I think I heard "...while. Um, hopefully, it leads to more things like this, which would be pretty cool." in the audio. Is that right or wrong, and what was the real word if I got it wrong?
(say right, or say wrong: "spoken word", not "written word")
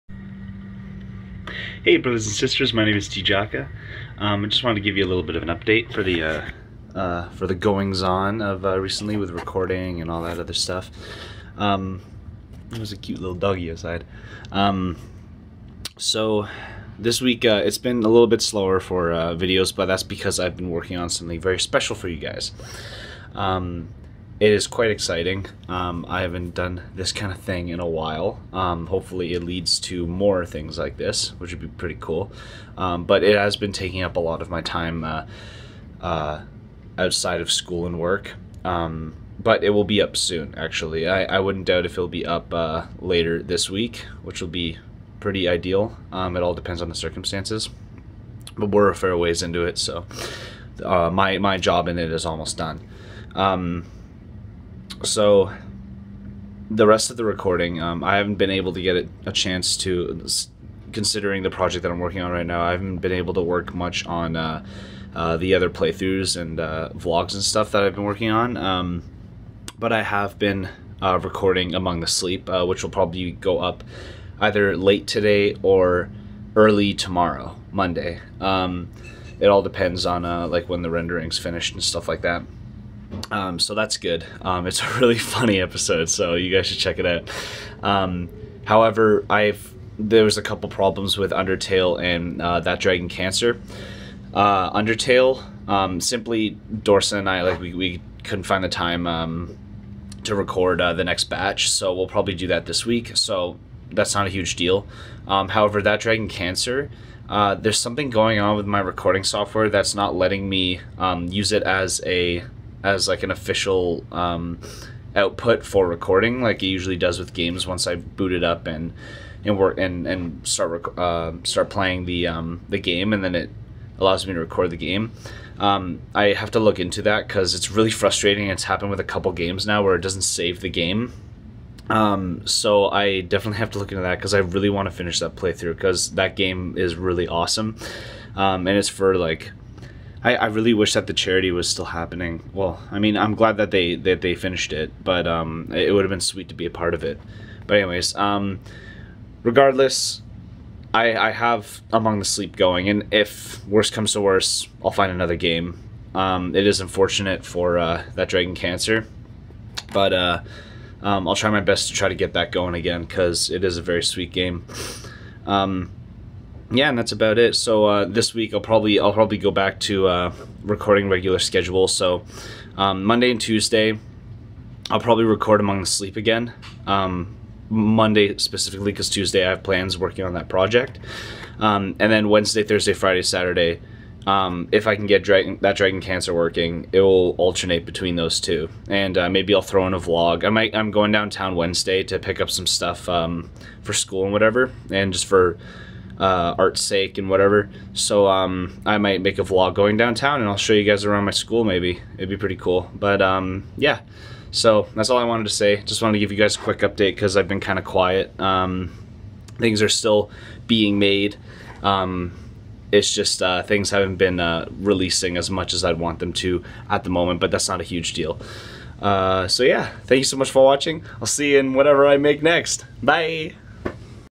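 right.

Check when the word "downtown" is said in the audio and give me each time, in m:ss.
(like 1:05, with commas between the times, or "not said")
3:11, 3:19.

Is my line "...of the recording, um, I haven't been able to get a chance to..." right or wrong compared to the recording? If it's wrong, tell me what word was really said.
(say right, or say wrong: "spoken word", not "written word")
right.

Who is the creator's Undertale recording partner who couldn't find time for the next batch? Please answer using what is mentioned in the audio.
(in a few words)
Dorson.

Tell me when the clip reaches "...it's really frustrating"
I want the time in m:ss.
2:07.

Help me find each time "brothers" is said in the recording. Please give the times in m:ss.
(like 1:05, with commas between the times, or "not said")
0:01.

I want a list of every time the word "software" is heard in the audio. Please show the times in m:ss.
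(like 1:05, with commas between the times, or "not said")
1:49.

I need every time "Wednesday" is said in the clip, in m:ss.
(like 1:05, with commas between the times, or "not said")
3:02, 3:11.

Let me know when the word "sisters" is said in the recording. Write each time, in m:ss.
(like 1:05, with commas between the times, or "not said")
0:02.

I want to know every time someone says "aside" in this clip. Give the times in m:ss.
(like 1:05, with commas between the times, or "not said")
0:13.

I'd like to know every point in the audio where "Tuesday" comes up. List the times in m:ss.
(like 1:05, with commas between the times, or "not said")
2:53, 2:59.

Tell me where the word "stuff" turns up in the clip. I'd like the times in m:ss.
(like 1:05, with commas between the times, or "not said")
0:10, 1:07, 1:21, 3:12.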